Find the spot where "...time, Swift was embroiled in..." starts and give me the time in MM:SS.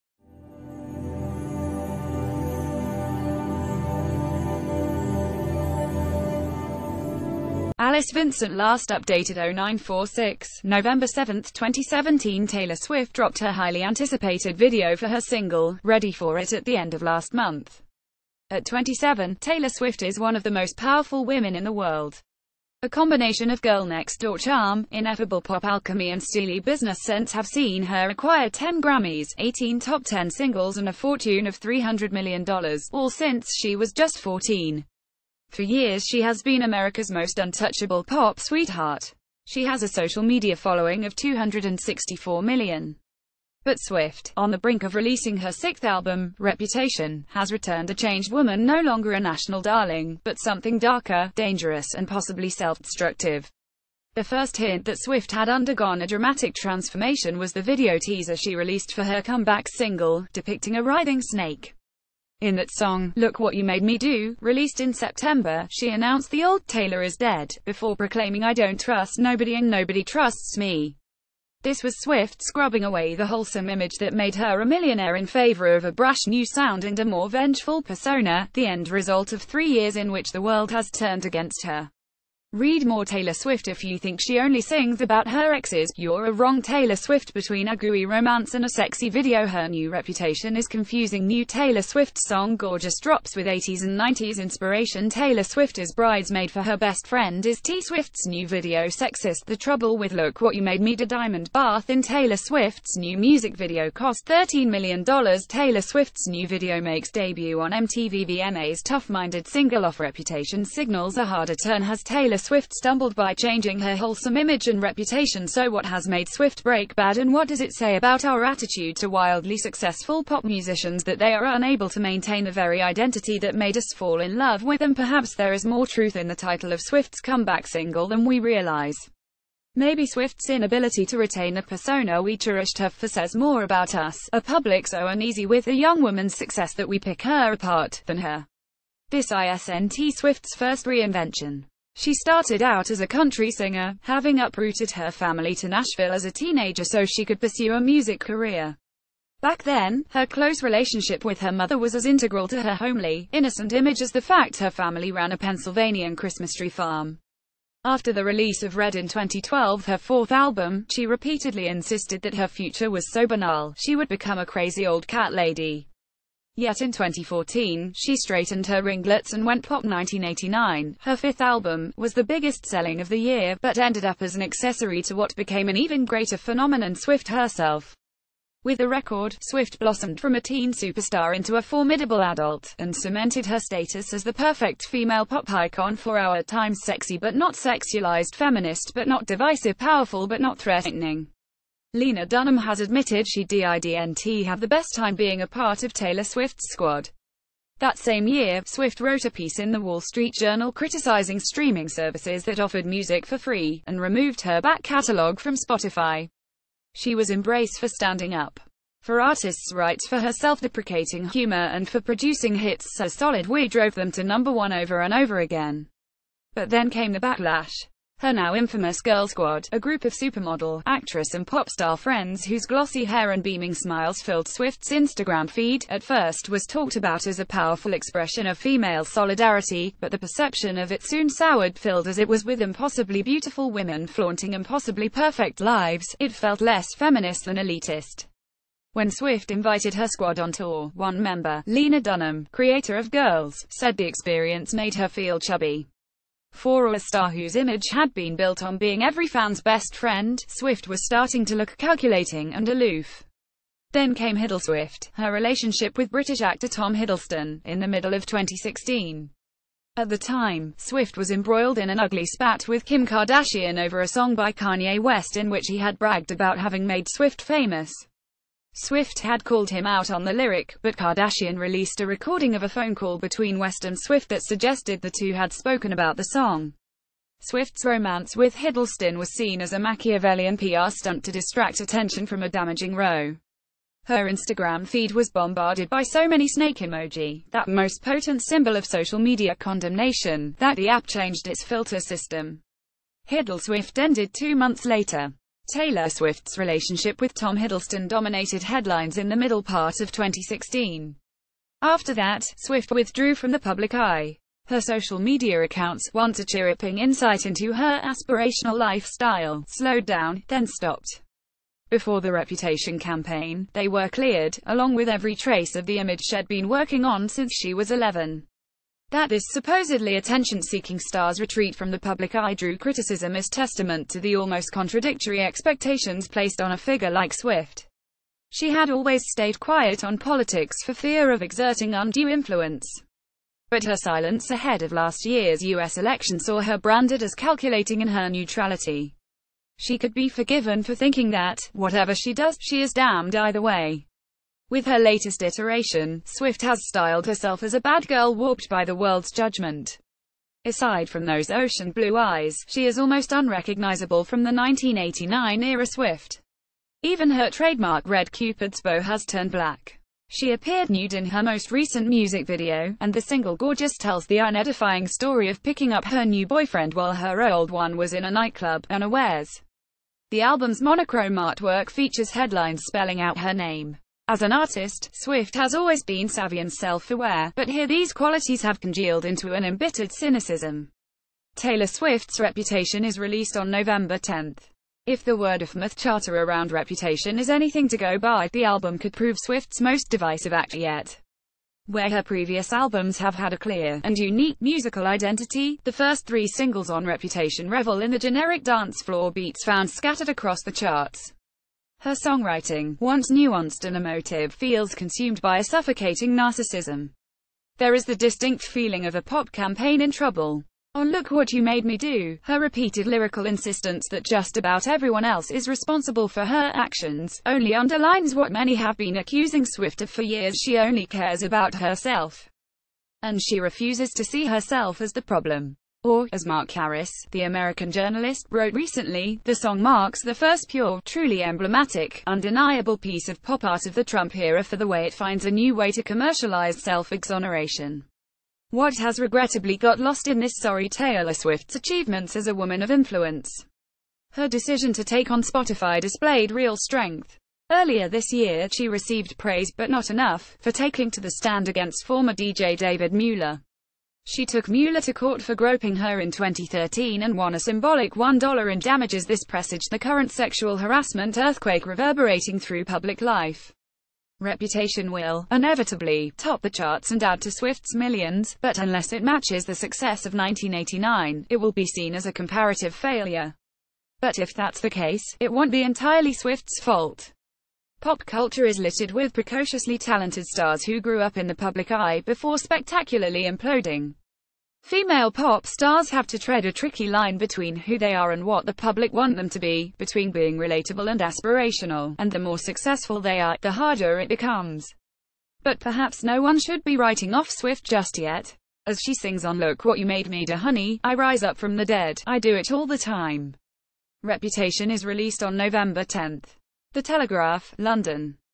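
04:20.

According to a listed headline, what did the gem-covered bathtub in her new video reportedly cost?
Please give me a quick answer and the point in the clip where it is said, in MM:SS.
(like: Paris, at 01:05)
$13 million, at 01:44.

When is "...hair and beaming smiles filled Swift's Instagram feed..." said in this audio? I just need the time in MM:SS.
03:43.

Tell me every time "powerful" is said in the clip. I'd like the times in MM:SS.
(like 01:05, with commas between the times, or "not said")
00:20, 03:09, 03:47.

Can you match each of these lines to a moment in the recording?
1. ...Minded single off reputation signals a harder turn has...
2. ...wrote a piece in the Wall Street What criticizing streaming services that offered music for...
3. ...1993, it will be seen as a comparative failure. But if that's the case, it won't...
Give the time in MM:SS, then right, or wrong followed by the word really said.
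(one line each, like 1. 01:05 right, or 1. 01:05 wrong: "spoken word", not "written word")
1. 01:49 right
2. 03:19 wrong: "Journal", not "What"
3. 07:50 wrong: "1989", not "1993".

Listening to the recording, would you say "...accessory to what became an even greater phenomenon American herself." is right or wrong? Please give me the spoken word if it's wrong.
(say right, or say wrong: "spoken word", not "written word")
wrong: "Swift", not "American".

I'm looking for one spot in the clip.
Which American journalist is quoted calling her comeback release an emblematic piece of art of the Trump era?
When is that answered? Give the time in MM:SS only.
07:06.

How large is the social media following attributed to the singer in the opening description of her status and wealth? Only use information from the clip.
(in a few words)
264 million.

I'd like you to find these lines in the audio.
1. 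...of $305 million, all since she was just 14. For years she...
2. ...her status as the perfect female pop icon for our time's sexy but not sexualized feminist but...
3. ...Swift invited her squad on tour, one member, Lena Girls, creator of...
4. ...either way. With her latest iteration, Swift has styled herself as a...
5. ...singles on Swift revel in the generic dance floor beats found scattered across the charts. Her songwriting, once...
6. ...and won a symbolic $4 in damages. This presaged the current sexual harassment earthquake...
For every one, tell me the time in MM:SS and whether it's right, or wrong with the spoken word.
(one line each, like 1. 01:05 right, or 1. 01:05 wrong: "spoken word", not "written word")
1. 00:31 wrong: "300", not "305"
2. 03:03 right
3. 03:59 wrong: "Dunham", not "Girls"
4. 05:43 right
5. 06:36 wrong: "Reputation", not "Swift"
6. 07:37 wrong: "1", not "4".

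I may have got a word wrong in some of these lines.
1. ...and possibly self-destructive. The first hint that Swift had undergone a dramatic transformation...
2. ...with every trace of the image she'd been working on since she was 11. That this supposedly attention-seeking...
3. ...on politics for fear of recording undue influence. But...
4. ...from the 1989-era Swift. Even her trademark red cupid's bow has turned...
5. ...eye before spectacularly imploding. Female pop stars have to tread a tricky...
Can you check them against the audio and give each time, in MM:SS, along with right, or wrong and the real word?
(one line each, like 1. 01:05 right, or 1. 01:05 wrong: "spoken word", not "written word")
1. 00:51 right
2. 05:14 right
3. 05:30 wrong: "exerting", not "recording"
4. 05:54 right
5. 08:01 right.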